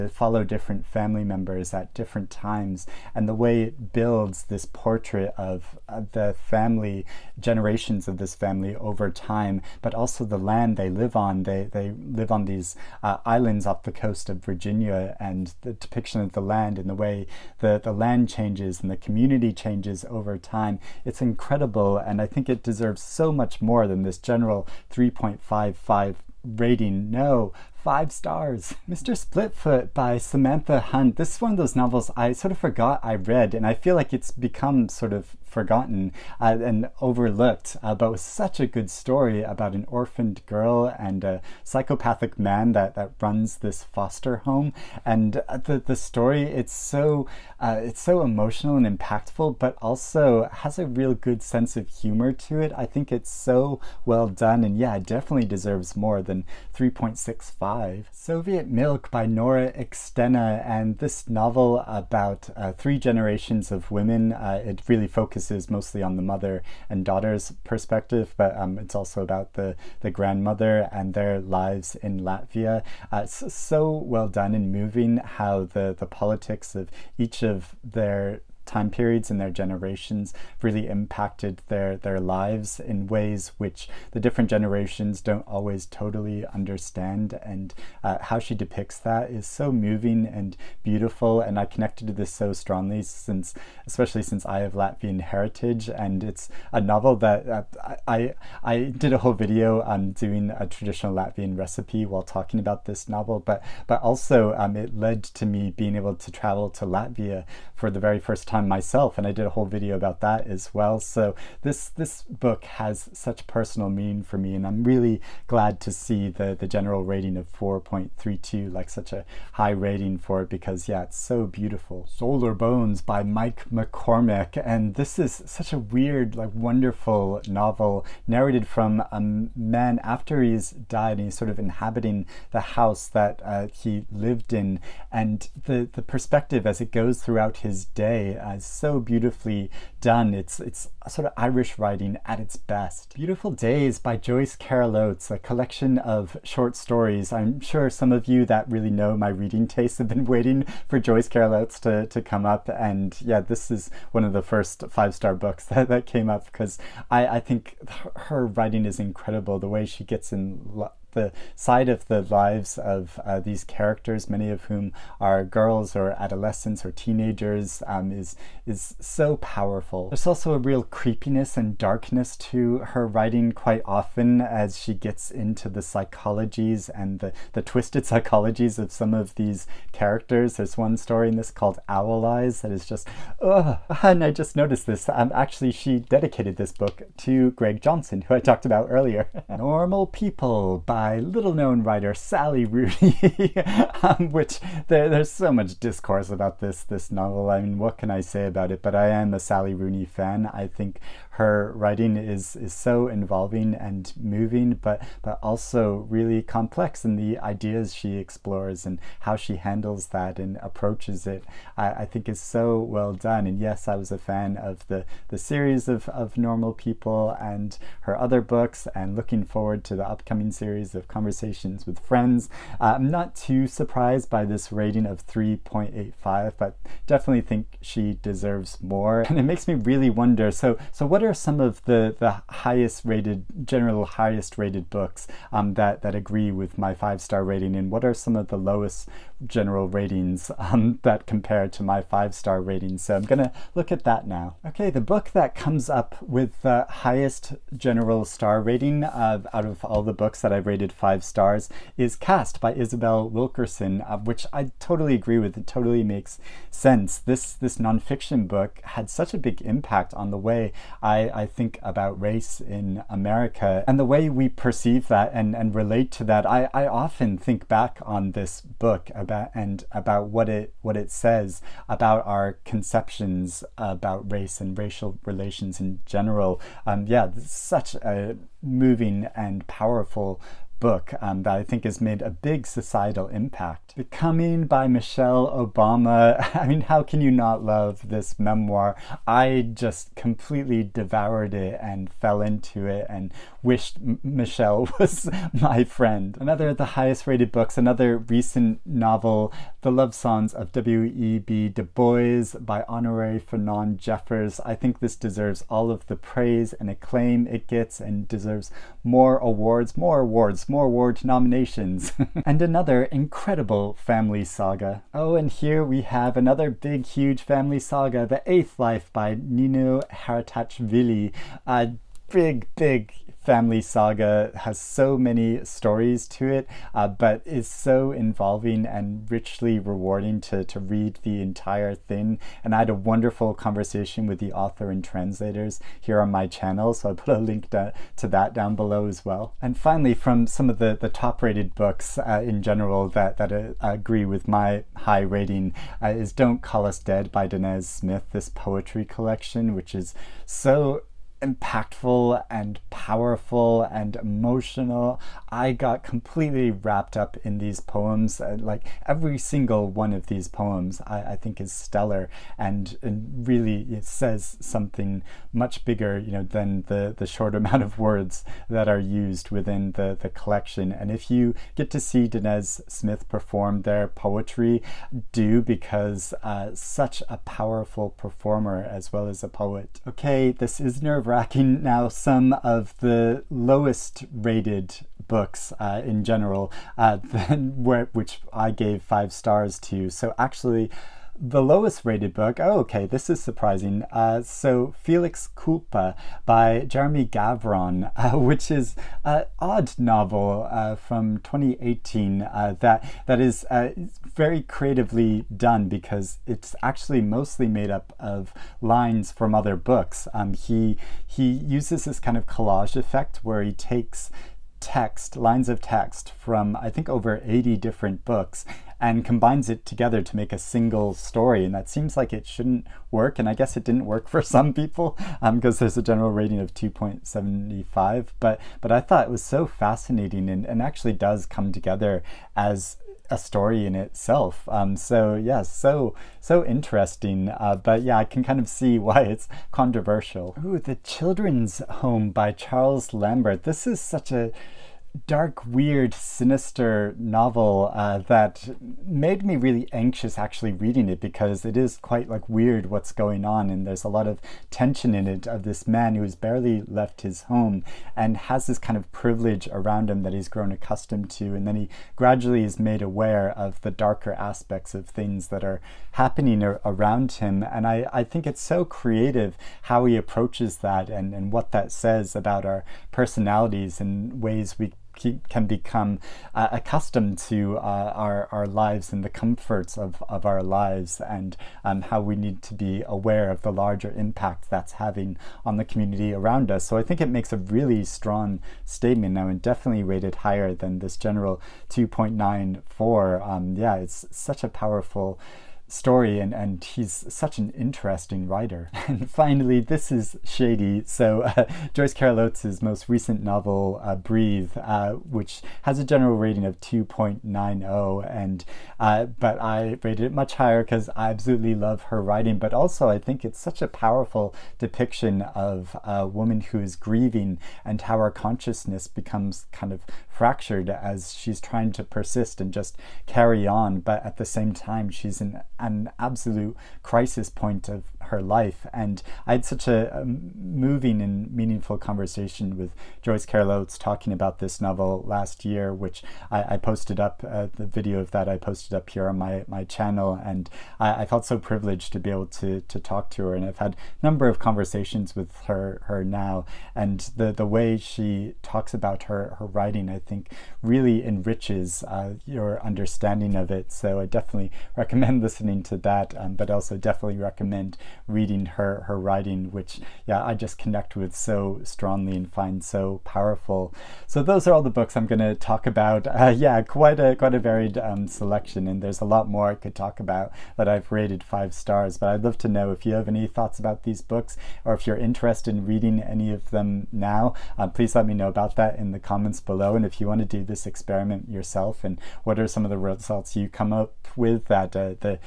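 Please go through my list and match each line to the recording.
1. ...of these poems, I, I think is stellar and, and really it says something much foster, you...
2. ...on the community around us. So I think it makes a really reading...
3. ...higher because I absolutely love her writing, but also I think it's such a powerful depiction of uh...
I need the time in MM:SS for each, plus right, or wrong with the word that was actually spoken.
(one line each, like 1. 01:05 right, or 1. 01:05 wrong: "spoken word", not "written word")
1. 06:00 wrong: "bigger", not "foster"
2. 08:05 wrong: "strong", not "reading"
3. 08:30 right.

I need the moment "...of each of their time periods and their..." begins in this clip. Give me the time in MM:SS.
01:16.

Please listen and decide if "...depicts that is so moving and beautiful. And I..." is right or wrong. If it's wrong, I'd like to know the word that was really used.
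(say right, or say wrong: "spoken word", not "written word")
right.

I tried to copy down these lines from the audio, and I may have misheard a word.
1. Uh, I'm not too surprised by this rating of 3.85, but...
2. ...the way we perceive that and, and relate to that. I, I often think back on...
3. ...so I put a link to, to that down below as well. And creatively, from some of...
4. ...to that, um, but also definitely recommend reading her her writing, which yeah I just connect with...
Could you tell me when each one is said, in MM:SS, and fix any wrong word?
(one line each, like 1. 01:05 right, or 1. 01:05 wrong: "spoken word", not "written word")
1. 03:42 right
2. 04:23 right
3. 05:36 wrong: "finally", not "creatively"
4. 09:15 right.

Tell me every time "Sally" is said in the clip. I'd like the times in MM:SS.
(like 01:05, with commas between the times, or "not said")
03:12, 03:19.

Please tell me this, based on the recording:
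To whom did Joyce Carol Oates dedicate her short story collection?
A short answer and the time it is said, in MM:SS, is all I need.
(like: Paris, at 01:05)
Greg Johnson, at 03:07.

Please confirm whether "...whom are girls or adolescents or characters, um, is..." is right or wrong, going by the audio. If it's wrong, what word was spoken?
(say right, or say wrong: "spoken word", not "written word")
wrong: "teenagers", not "characters".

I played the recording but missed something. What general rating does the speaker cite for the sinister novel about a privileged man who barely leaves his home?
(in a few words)
2.94.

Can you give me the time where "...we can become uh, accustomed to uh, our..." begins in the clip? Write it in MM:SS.
07:54.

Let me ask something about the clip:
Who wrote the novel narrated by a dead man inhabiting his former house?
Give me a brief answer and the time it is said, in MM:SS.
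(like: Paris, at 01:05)
Mike McCormack, at 02:03.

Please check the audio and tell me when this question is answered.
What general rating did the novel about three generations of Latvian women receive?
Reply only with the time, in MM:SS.
01:57.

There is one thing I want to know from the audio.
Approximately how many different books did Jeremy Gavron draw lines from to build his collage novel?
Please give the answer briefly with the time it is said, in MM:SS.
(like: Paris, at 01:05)
Over 80, at 06:57.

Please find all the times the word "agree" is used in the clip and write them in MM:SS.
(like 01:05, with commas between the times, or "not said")
03:56, 04:15, 05:43.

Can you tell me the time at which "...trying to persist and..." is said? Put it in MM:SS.
08:41.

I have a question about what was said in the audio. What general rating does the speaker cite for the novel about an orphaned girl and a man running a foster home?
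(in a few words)
3.65.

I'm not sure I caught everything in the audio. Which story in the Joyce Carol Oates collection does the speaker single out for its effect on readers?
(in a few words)
Owl Eyes.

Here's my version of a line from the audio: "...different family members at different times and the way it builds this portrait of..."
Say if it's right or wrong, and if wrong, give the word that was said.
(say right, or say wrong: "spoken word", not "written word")
right.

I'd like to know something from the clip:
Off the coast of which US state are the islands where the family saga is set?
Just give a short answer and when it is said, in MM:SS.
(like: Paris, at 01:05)
Virginia, at 00:14.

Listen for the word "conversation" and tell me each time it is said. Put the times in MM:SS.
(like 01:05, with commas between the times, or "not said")
03:41, 05:33, 08:51, 09:04.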